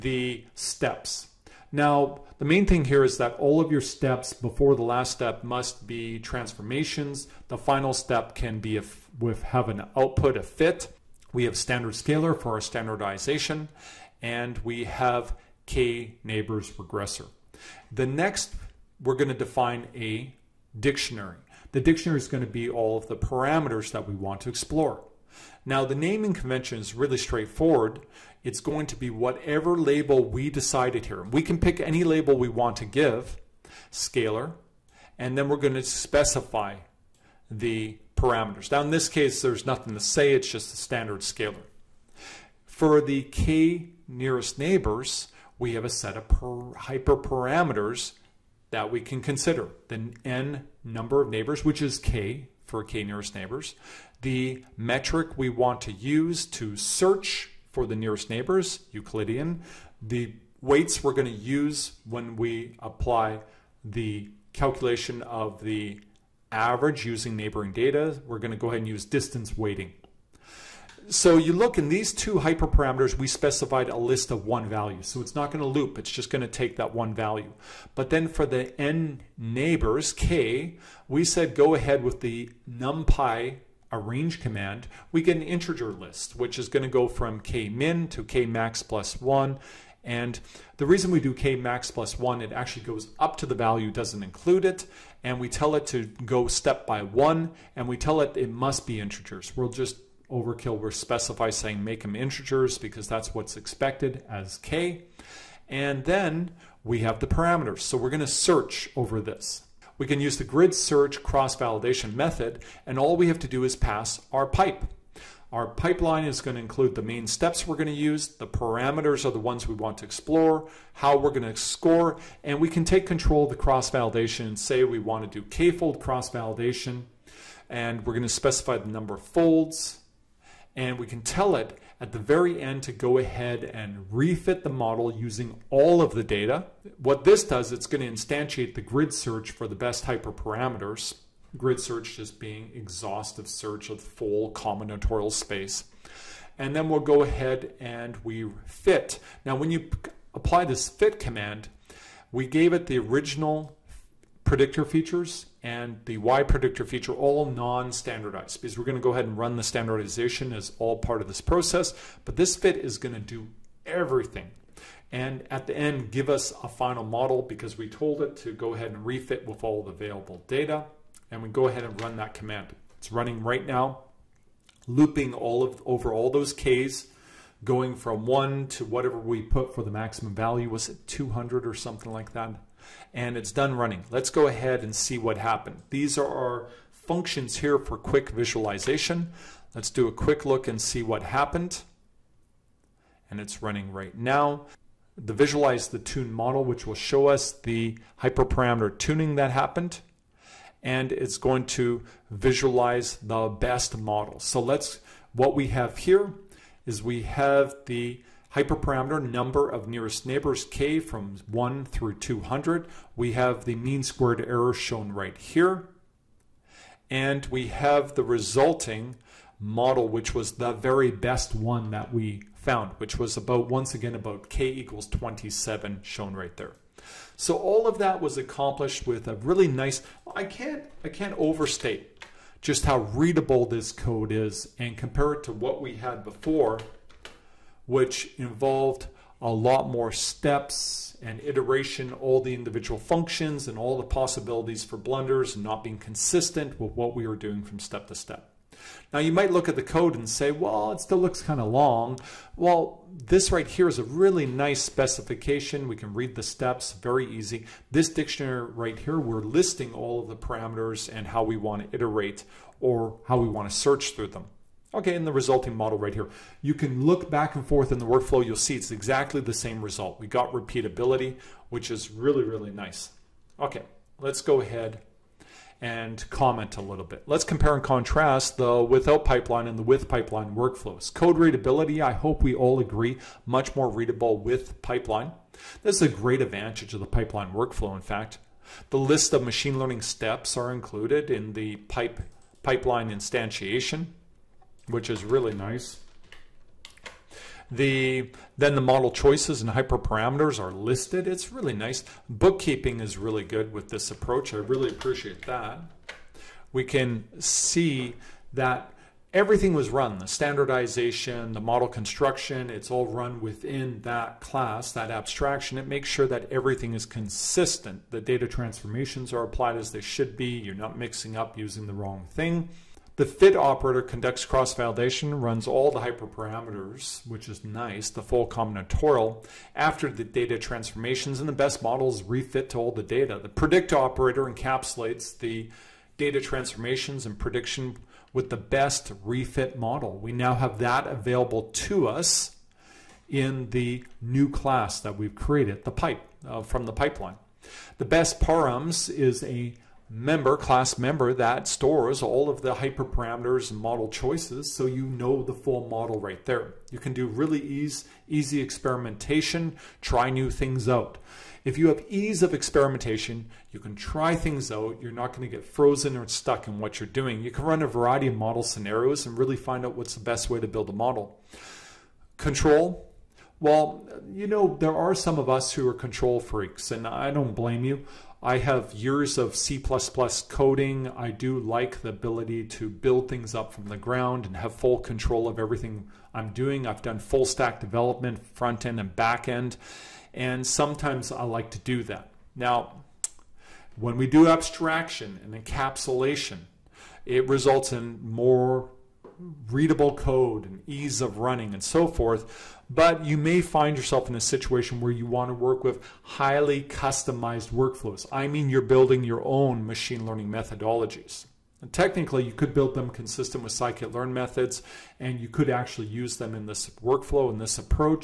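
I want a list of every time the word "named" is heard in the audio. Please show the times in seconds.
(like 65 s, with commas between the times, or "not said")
not said.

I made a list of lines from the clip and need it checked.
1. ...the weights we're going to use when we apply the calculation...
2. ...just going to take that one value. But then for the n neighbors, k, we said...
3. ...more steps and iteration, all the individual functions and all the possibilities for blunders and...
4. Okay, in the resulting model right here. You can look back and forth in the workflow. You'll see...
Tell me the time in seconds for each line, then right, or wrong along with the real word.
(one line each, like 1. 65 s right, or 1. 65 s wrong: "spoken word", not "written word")
1. 60 s right
2. 76 s right
3. 239 s right
4. 264 s right.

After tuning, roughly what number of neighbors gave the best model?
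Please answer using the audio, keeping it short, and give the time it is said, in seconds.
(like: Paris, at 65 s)
27, at 225 s.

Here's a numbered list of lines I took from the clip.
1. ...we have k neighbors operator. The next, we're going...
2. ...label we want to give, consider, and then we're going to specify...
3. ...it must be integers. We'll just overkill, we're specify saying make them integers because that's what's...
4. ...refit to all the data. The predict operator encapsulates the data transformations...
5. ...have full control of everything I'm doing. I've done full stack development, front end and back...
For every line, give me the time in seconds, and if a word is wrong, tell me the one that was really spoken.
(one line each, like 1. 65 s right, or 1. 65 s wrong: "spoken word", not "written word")
1. 14 s wrong: "regressor", not "operator"
2. 32 s wrong: "scaler", not "consider"
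3. 98 s right
4. 332 s right
5. 384 s right.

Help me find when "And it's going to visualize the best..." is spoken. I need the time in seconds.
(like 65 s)
200 s.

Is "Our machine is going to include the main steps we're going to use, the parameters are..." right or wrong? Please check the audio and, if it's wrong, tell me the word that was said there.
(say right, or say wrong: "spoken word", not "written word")
wrong: "pipeline", not "machine".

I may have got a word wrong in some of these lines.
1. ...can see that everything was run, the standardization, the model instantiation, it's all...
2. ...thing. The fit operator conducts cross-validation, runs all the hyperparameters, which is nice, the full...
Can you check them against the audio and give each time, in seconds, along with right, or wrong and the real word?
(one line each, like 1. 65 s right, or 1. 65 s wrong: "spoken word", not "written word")
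1. 306 s wrong: "construction", not "instantiation"
2. 322 s right.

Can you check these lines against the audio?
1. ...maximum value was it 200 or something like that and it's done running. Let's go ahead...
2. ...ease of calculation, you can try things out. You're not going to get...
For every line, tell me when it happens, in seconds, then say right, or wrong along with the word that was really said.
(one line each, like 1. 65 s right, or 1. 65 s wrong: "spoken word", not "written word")
1. 179 s right
2. 362 s wrong: "experimentation", not "calculation".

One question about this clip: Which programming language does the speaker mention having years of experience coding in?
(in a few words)
C++.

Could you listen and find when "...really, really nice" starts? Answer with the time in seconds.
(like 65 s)
272 s.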